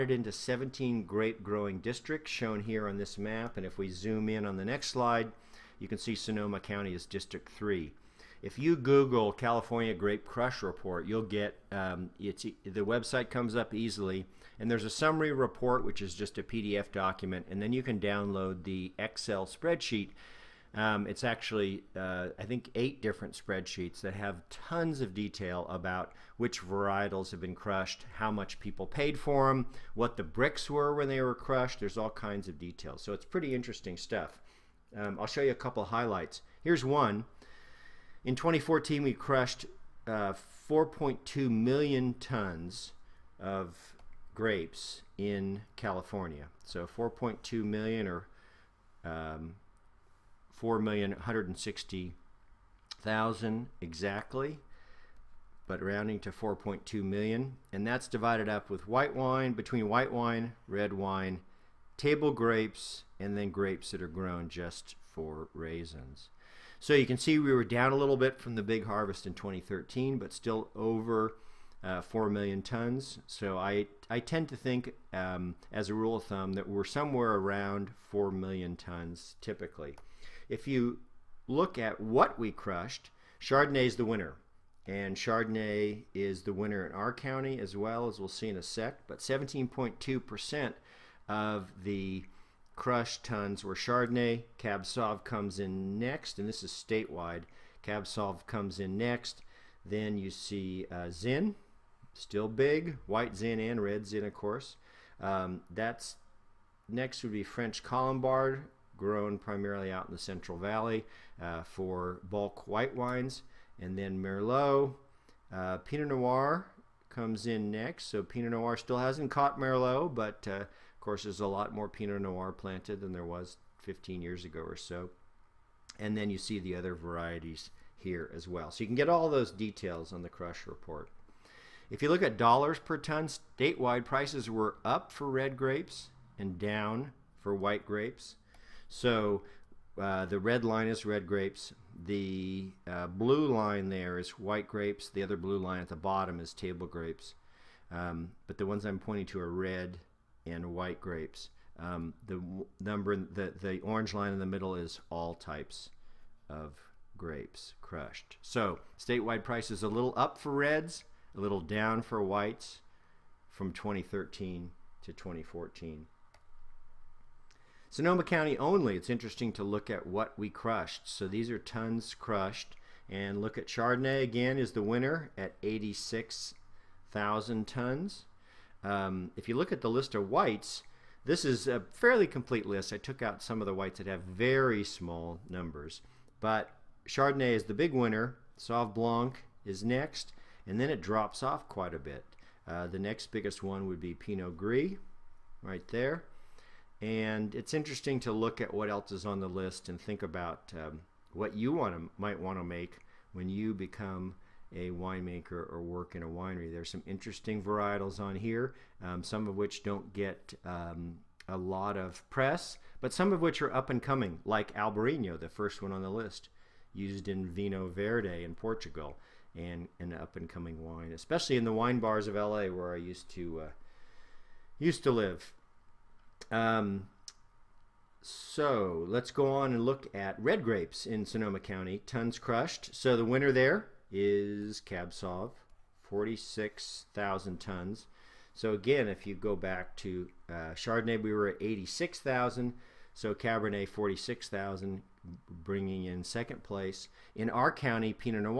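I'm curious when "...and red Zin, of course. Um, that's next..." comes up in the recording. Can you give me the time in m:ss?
1:43.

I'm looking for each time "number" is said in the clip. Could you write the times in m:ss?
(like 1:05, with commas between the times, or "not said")
2:32, 3:05.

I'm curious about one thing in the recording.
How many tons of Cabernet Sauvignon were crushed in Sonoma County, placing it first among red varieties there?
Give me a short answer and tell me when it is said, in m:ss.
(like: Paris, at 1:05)
46,000 tons, at 3:56.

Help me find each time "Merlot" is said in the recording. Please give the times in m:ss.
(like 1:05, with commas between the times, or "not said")
1:54, 1:59.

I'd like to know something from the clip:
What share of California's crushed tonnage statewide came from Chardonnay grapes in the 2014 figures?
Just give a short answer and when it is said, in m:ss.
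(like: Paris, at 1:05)
17.2%, at 1:29.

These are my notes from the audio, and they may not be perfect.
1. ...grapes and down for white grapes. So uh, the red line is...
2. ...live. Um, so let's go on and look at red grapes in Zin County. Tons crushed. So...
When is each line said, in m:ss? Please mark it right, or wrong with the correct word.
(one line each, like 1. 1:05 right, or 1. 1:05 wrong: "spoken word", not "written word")
1. 2:15 right
2. 3:45 wrong: "Sonoma", not "Zin".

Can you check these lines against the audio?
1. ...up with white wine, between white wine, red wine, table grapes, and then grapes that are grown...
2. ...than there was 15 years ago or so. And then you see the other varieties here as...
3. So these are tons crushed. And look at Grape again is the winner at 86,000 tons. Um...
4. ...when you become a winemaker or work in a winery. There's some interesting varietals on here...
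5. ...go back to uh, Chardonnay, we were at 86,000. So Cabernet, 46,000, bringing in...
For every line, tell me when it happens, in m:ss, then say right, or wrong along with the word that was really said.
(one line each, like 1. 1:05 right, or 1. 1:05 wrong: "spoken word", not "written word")
1. 0:58 right
2. 2:02 right
3. 2:51 wrong: "Chardonnay", not "Grape"
4. 3:23 right
5. 3:59 right.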